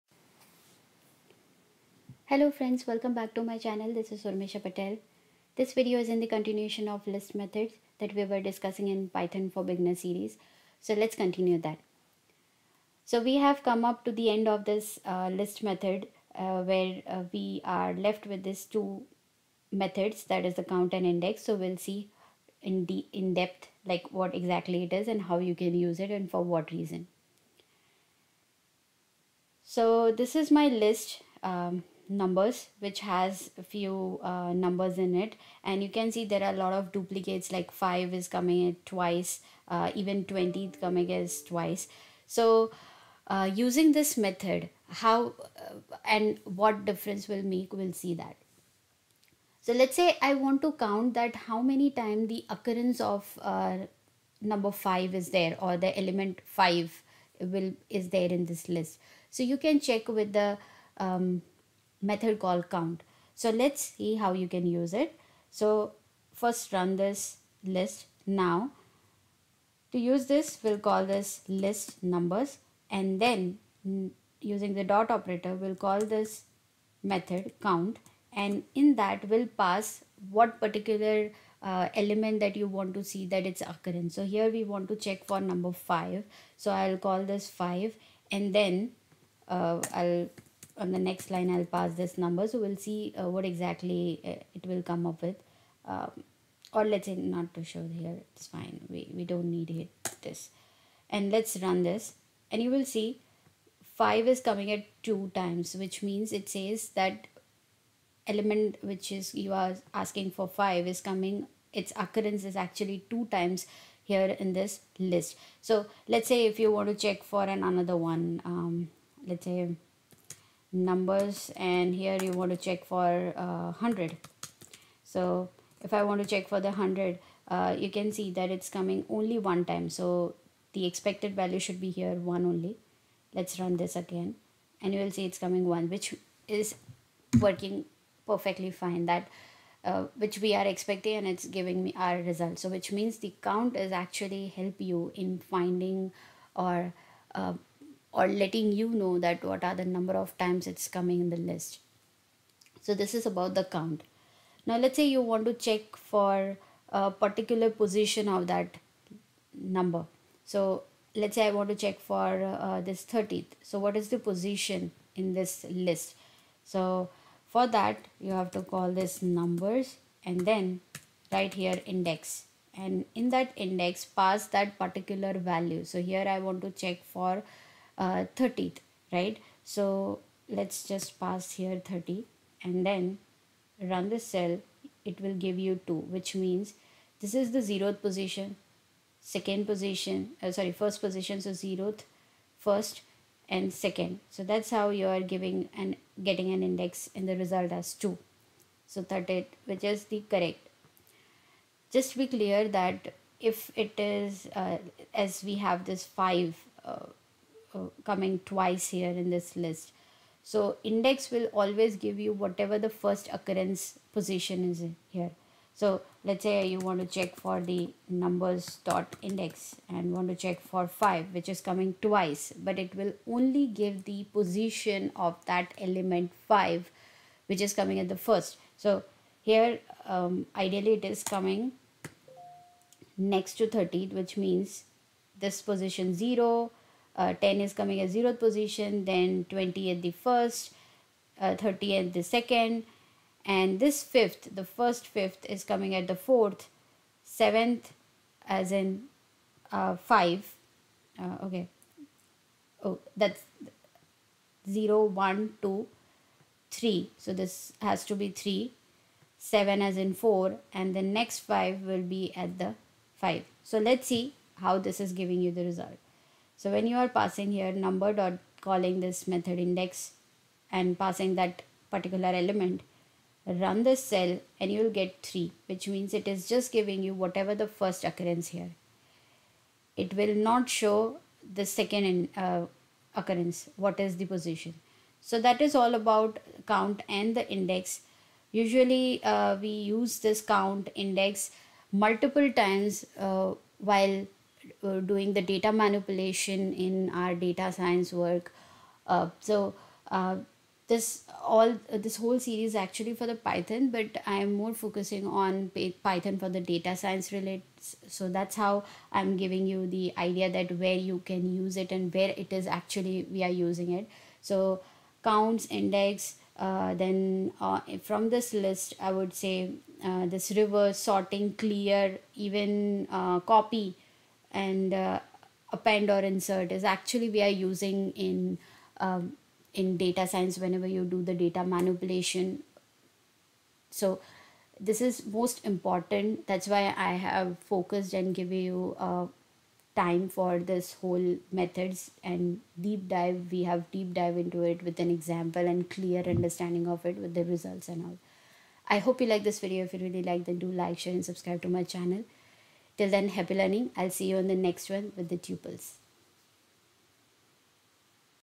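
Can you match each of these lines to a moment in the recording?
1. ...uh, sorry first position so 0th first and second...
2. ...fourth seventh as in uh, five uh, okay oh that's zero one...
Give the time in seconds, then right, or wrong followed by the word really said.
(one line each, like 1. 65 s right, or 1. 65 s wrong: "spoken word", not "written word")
1. 190 s right
2. 246 s right.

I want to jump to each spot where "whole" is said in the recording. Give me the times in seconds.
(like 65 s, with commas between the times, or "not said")
302 s, 341 s.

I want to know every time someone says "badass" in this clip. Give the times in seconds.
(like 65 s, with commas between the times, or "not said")
not said.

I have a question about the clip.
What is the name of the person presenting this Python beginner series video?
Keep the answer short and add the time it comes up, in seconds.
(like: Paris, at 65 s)
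Urmisha Patel, at 4 s.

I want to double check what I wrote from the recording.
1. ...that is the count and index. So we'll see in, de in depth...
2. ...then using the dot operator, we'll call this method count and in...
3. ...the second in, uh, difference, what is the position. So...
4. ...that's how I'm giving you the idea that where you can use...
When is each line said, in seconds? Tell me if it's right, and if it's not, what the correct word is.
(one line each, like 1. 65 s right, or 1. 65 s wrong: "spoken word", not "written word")
1. 20 s right
2. 73 s right
3. 281 s wrong: "occurrence", not "difference"
4. 308 s right.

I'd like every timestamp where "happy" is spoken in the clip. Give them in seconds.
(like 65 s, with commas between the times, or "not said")
353 s.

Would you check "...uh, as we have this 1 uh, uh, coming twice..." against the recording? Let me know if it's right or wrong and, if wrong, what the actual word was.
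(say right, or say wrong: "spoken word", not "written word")
wrong: "5", not "1".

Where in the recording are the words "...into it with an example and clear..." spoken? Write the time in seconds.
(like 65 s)
344 s.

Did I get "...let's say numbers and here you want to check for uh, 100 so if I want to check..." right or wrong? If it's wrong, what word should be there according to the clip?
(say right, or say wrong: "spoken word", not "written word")
right.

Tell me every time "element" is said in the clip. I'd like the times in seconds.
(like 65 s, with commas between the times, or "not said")
56 s, 81 s, 108 s, 225 s, 272 s.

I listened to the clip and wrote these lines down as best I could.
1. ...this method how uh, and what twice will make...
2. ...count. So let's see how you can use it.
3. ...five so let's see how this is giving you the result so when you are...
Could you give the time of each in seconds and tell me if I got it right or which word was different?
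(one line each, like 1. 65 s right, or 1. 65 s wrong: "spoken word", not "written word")
1. 43 s wrong: "difference", not "twice"
2. 62 s right
3. 263 s right.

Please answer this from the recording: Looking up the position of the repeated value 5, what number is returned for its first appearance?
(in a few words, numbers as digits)
3.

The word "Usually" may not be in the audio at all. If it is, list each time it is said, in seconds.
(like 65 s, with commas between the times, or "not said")
288 s.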